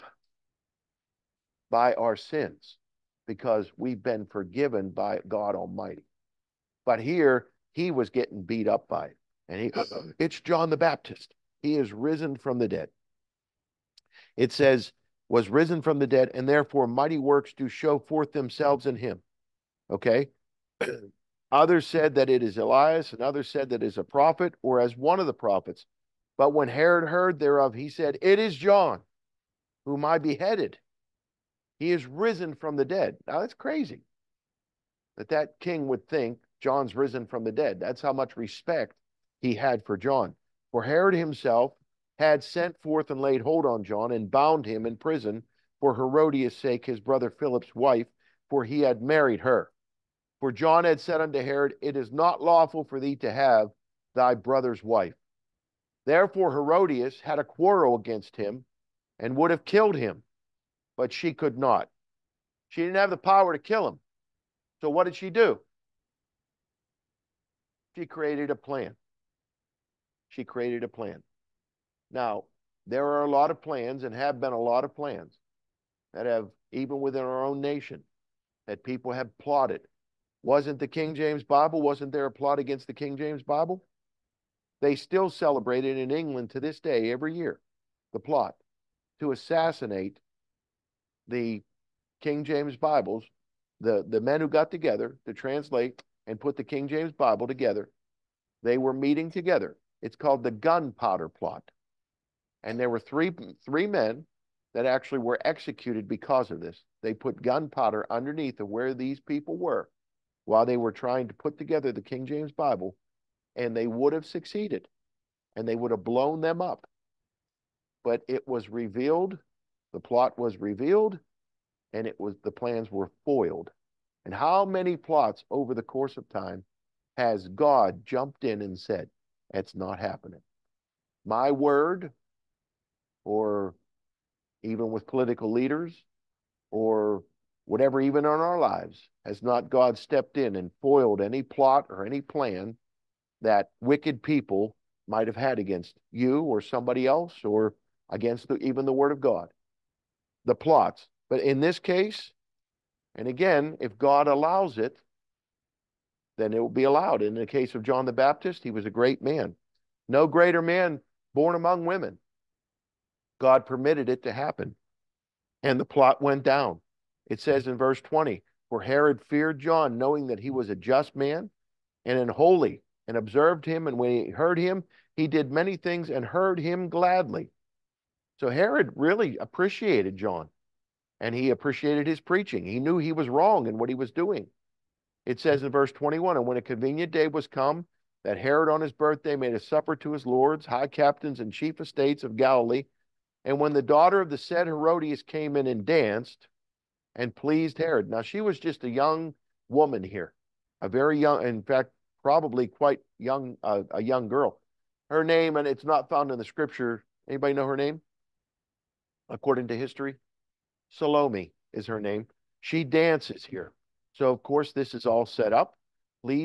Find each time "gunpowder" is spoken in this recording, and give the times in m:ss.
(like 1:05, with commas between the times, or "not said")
1:40, 1:47.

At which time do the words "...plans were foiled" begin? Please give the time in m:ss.
2:02.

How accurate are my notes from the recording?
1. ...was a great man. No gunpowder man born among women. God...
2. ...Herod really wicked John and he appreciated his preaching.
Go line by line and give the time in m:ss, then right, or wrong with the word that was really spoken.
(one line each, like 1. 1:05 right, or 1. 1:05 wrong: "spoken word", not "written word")
1. 2:38 wrong: "greater", not "gunpowder"
2. 2:58 wrong: "appreciated", not "wicked".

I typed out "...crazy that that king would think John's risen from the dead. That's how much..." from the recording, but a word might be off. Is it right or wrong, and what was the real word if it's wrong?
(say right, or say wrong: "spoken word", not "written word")
right.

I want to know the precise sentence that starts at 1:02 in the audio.
She didn't have the power to kill him.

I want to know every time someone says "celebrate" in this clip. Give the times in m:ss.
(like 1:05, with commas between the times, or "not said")
1:25.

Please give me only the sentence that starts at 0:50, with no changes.
For John had said unto Herod, It is not lawful for thee to have thy brother's wife.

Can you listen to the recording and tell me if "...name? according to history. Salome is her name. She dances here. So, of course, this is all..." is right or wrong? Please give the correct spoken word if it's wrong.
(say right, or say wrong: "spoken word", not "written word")
right.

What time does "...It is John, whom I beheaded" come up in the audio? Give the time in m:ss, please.
0:28.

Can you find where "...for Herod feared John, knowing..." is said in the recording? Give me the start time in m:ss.
2:48.